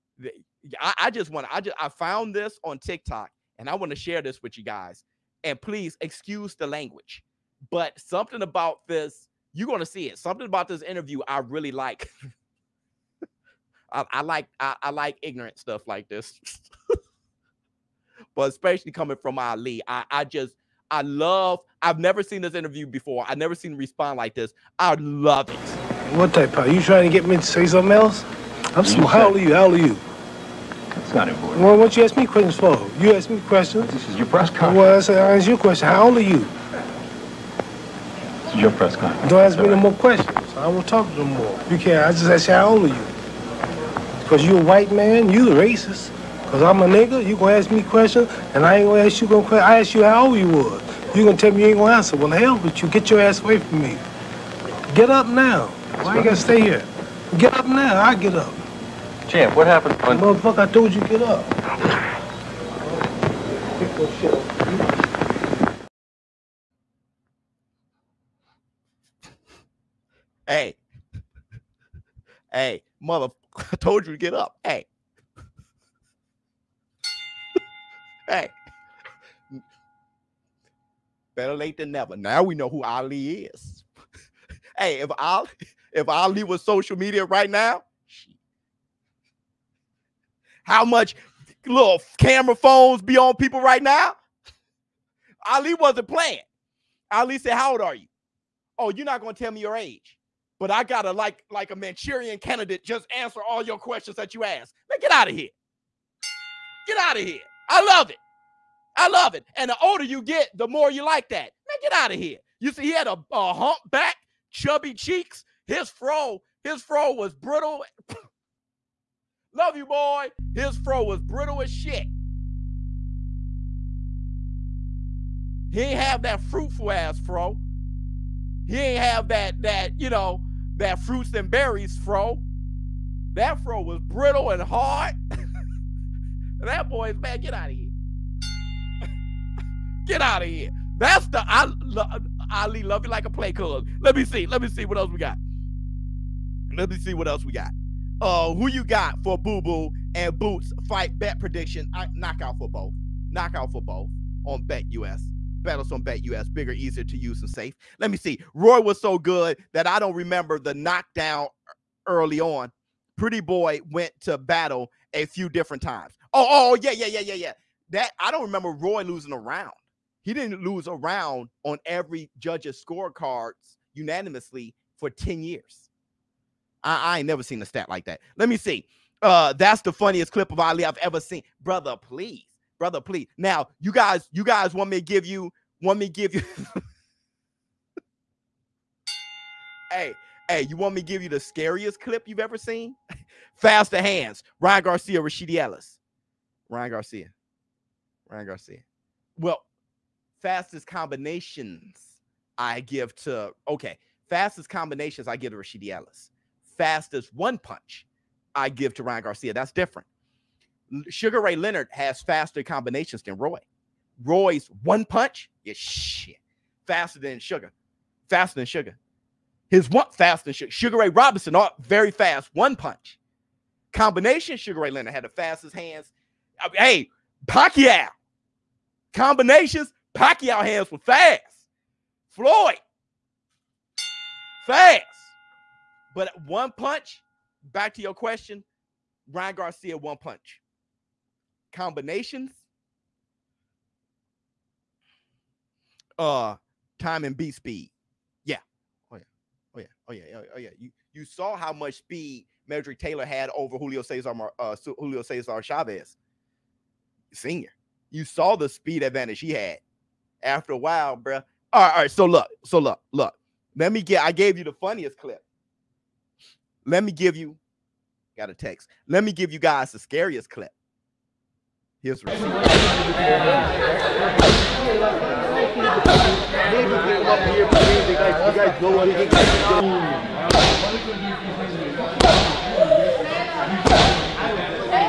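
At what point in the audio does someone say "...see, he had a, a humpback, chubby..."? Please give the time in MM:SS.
01:52.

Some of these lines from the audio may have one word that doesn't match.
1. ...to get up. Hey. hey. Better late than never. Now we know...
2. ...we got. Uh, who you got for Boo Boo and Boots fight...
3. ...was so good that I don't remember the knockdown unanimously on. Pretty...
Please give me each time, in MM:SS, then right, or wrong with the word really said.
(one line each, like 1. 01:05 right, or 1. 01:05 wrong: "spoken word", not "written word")
1. 01:14 right
2. 02:27 right
3. 02:38 wrong: "early", not "unanimously".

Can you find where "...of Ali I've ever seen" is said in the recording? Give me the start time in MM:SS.
03:00.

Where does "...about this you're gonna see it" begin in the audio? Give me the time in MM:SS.
00:08.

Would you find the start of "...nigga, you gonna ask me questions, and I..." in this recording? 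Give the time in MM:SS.
00:46.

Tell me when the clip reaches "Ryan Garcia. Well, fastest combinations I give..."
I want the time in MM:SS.
03:18.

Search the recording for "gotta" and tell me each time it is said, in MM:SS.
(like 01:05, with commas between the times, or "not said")
00:56, 01:40.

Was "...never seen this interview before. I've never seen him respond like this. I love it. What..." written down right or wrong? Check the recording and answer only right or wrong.
right.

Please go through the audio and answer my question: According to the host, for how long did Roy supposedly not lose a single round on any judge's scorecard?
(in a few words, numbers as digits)
10 years.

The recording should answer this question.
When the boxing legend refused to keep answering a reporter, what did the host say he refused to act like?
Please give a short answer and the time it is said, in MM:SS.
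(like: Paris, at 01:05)
Manchurian candidate, at 01:41.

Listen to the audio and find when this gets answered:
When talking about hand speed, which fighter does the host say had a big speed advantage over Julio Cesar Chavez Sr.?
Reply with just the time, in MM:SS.
04:12.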